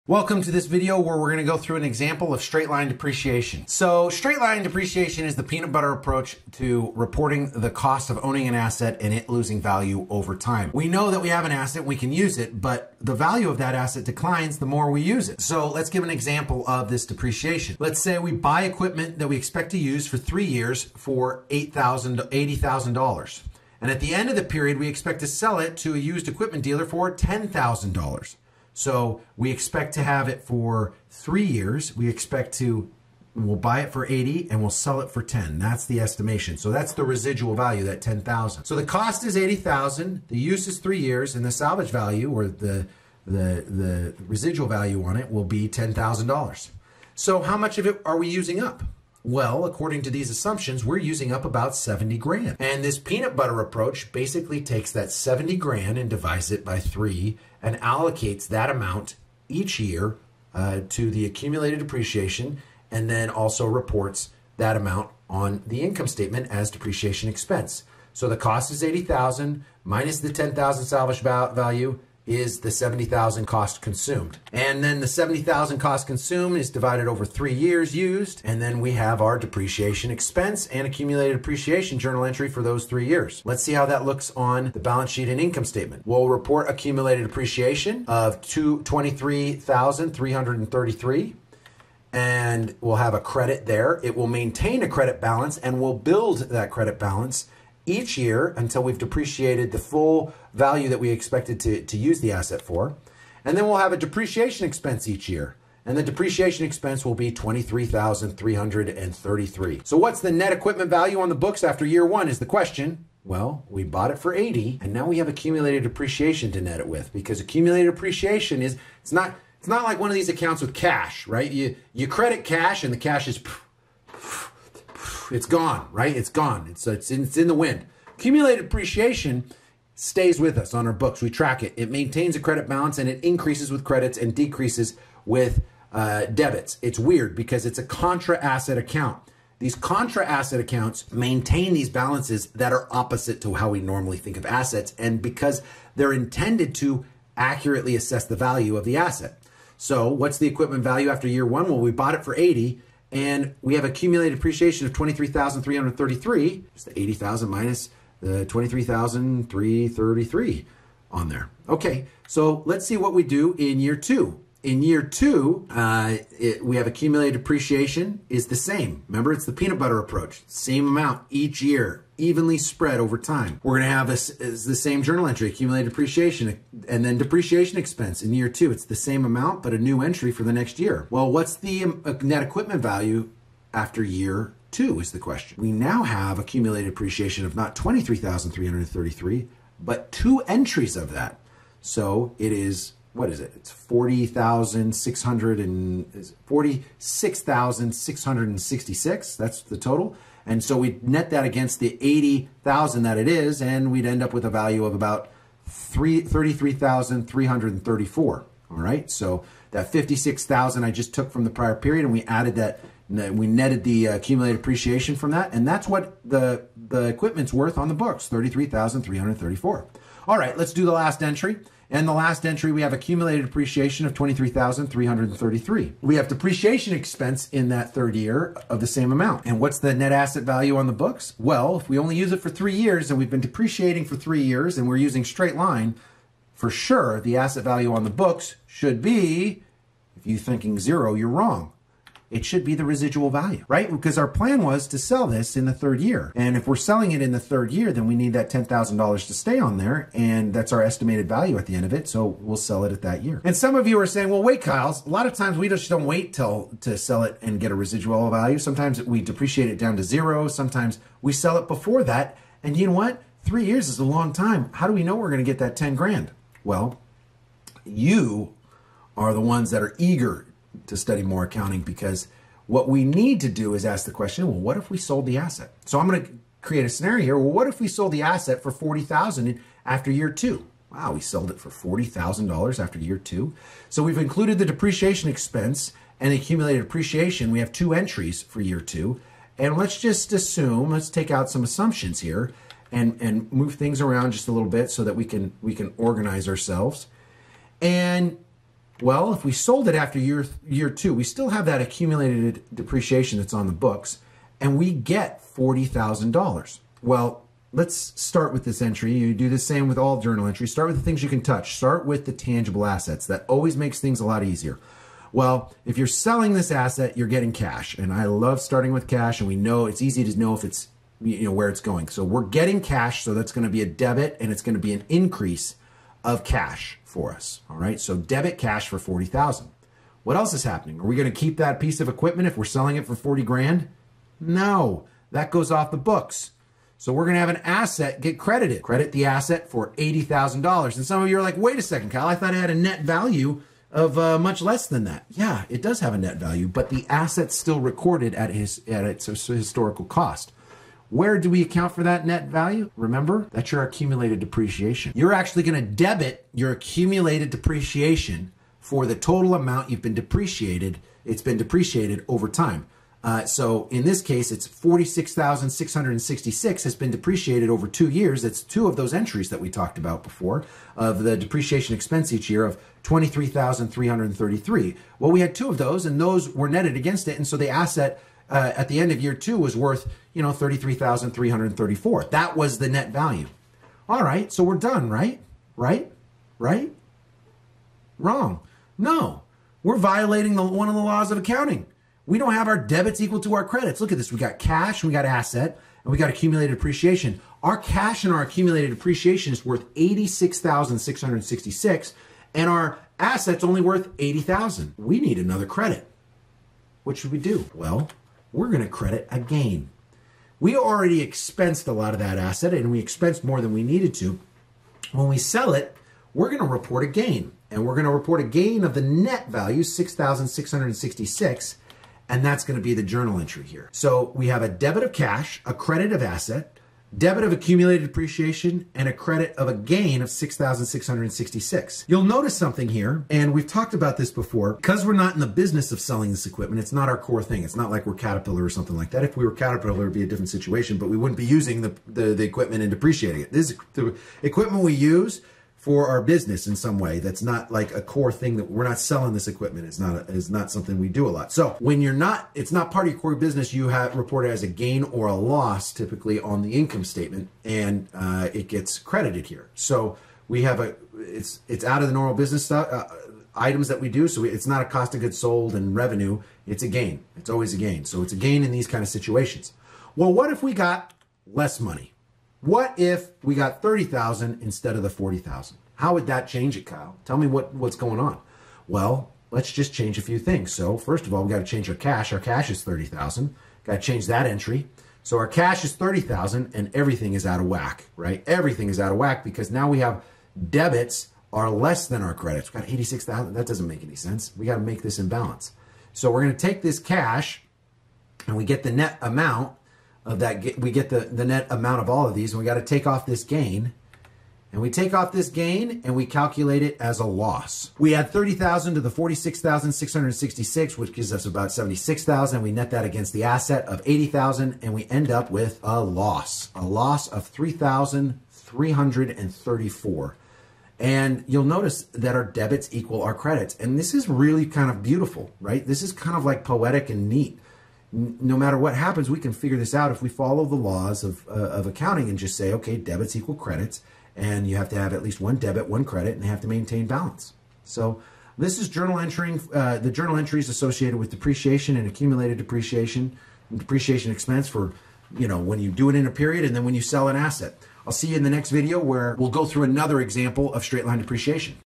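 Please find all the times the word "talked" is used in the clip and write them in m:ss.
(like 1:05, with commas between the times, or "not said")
6:09, 7:13.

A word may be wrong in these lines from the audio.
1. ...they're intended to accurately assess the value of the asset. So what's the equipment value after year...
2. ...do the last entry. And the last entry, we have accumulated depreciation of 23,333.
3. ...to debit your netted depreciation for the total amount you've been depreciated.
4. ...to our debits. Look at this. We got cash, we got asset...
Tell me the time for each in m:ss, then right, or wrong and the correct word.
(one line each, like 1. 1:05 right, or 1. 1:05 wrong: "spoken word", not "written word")
1. 2:25 right
2. 3:40 right
3. 5:55 wrong: "accumulated", not "netted"
4. 6:33 wrong: "credits", not "debits".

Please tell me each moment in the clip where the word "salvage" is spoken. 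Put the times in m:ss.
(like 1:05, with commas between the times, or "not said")
0:41, 1:10.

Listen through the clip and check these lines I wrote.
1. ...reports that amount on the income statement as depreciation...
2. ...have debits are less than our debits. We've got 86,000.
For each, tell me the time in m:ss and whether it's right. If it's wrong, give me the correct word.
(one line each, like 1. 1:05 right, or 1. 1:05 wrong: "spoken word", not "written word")
1. 1:03 right
2. 8:09 wrong: "credits", not "debits".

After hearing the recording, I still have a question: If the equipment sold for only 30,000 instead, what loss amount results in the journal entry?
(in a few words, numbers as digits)
3,334.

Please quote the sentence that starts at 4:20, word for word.
Sometimes we sell it before that.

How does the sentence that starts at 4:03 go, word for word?
Because our plan was to sell this in the third year.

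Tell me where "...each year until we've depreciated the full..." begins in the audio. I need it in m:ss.
1:37.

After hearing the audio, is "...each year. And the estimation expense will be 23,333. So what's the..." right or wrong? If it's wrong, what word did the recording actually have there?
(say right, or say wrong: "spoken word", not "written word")
wrong: "depreciation", not "estimation".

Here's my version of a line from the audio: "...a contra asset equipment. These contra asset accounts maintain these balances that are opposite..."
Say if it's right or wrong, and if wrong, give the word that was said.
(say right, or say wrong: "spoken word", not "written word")
wrong: "account", not "equipment".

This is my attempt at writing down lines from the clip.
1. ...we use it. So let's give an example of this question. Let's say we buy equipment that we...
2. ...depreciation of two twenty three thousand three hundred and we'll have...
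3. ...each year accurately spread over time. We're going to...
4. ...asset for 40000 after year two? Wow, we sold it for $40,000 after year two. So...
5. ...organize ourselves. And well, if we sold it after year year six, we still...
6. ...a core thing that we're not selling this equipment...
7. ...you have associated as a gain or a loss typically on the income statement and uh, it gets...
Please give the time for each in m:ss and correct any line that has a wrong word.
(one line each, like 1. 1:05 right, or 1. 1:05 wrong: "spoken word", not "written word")
1. 0:14 wrong: "depreciation", not "question"
2. 1:27 right
3. 2:51 wrong: "evenly", not "accurately"
4. 4:38 right
5. 4:55 wrong: "two", not "six"
6. 7:27 right
7. 7:33 wrong: "reported", not "associated".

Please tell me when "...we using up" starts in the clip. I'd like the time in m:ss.
0:48.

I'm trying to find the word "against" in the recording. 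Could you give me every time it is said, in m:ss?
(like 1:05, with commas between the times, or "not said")
3:21, 6:16, 8:33.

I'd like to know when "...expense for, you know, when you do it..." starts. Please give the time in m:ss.
9:04.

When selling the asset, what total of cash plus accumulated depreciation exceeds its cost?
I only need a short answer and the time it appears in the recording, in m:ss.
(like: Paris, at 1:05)
86,666, at 6:39.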